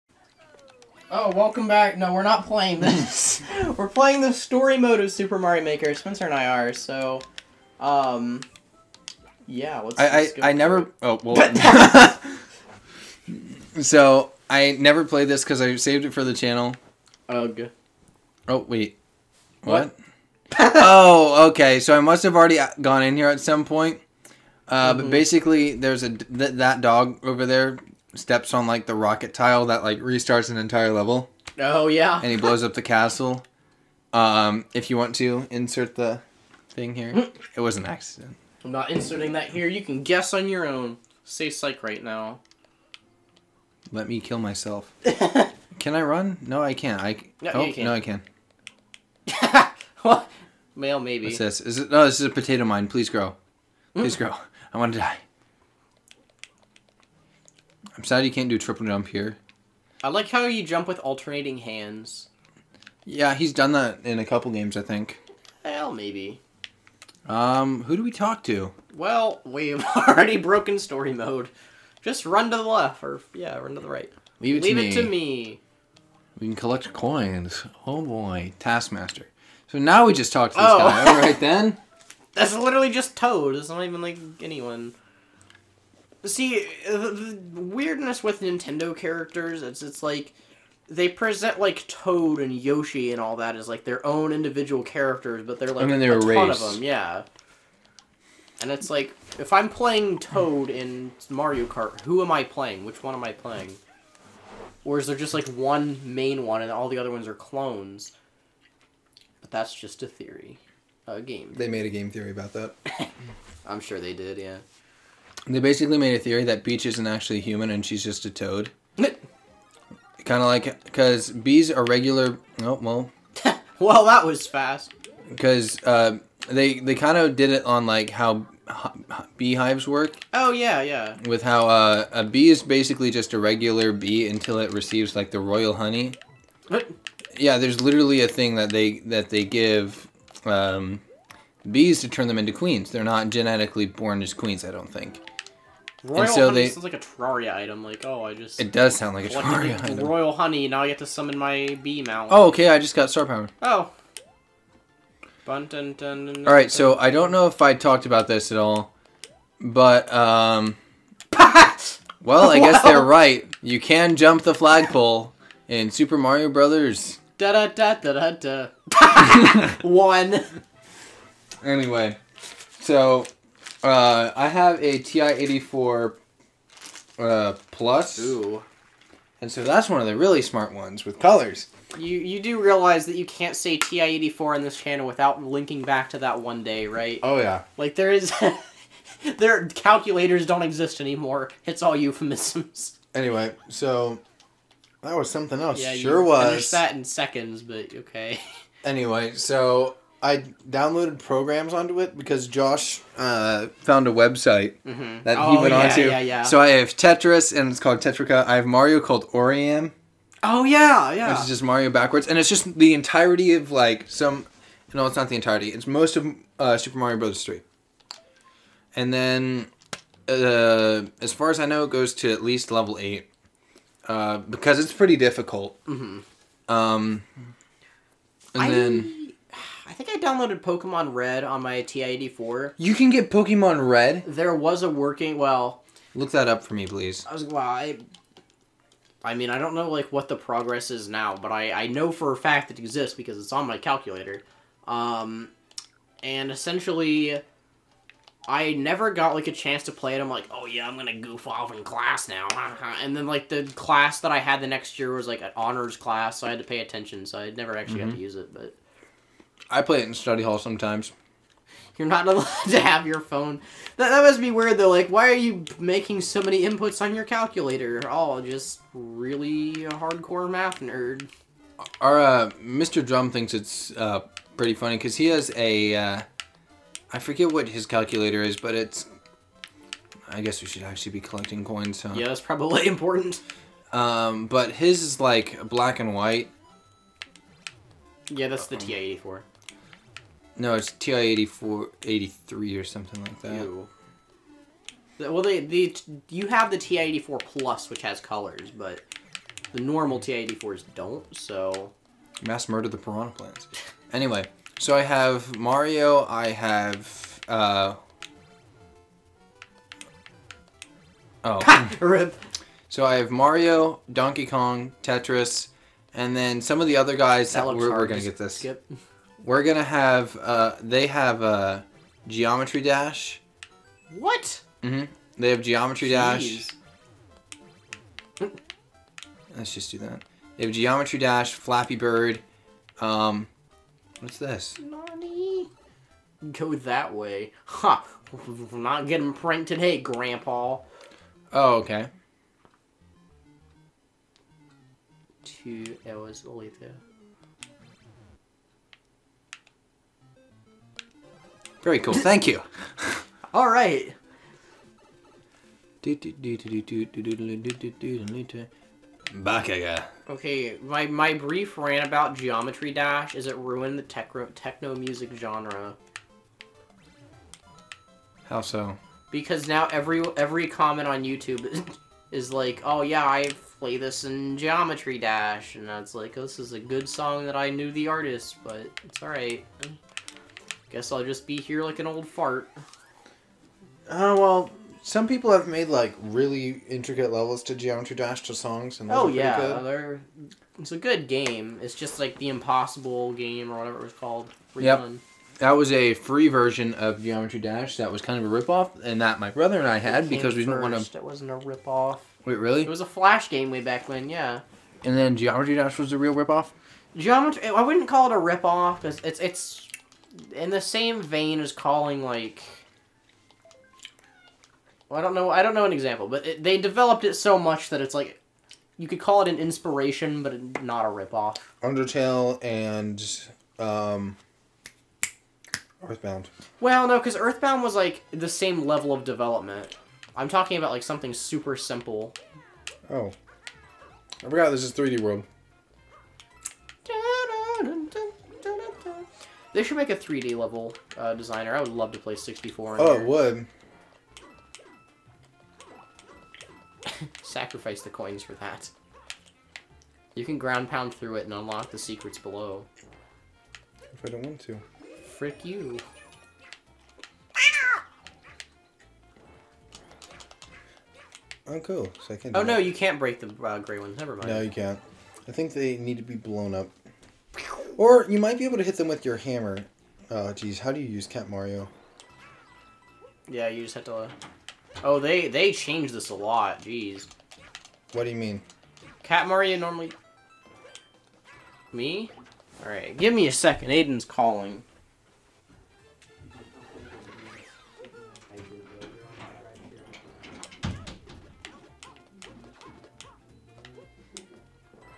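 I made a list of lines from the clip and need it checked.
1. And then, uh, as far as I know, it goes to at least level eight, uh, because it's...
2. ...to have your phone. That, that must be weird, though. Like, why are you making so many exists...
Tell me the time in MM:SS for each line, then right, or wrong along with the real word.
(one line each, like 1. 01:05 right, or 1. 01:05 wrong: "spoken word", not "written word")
1. 03:38 right
2. 04:22 wrong: "inputs", not "exists".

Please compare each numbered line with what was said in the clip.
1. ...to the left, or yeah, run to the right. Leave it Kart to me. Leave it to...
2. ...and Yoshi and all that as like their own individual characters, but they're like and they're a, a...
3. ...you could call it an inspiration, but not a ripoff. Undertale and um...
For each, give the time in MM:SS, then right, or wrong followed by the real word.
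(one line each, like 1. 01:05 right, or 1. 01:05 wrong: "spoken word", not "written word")
1. 01:12 wrong: "Leave", not "Kart"
2. 01:32 right
3. 06:58 right.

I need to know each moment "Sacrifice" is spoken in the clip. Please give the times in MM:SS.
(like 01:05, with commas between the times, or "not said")
07:27.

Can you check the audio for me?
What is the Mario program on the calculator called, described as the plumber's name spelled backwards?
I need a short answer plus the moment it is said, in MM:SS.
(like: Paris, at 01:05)
Oriam, at 03:29.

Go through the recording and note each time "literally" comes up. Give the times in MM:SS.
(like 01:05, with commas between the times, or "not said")
01:22, 02:17.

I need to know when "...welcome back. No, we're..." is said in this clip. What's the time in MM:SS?
00:01.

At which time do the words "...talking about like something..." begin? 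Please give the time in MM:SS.
07:10.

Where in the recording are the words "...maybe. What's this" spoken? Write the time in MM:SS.
00:50.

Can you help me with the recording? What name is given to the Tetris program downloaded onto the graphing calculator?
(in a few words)
Tetrica.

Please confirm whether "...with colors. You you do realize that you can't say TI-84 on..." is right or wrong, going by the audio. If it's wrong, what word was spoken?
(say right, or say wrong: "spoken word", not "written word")
right.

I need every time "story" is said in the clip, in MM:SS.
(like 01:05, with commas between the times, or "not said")
00:04, 01:10.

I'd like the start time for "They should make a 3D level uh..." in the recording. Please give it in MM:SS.
07:19.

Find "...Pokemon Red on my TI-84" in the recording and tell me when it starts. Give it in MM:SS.
03:50.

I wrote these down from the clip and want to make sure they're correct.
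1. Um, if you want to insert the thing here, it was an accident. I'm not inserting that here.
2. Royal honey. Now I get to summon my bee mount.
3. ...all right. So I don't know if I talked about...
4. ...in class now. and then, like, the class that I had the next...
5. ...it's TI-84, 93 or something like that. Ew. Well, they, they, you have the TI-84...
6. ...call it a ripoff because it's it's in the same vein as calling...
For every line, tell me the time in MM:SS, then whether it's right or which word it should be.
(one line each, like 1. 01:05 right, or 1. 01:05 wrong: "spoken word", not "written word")
1. 00:34 right
2. 02:29 right
3. 02:36 right
4. 04:11 right
5. 04:50 wrong: "83", not "93"
6. 06:48 right.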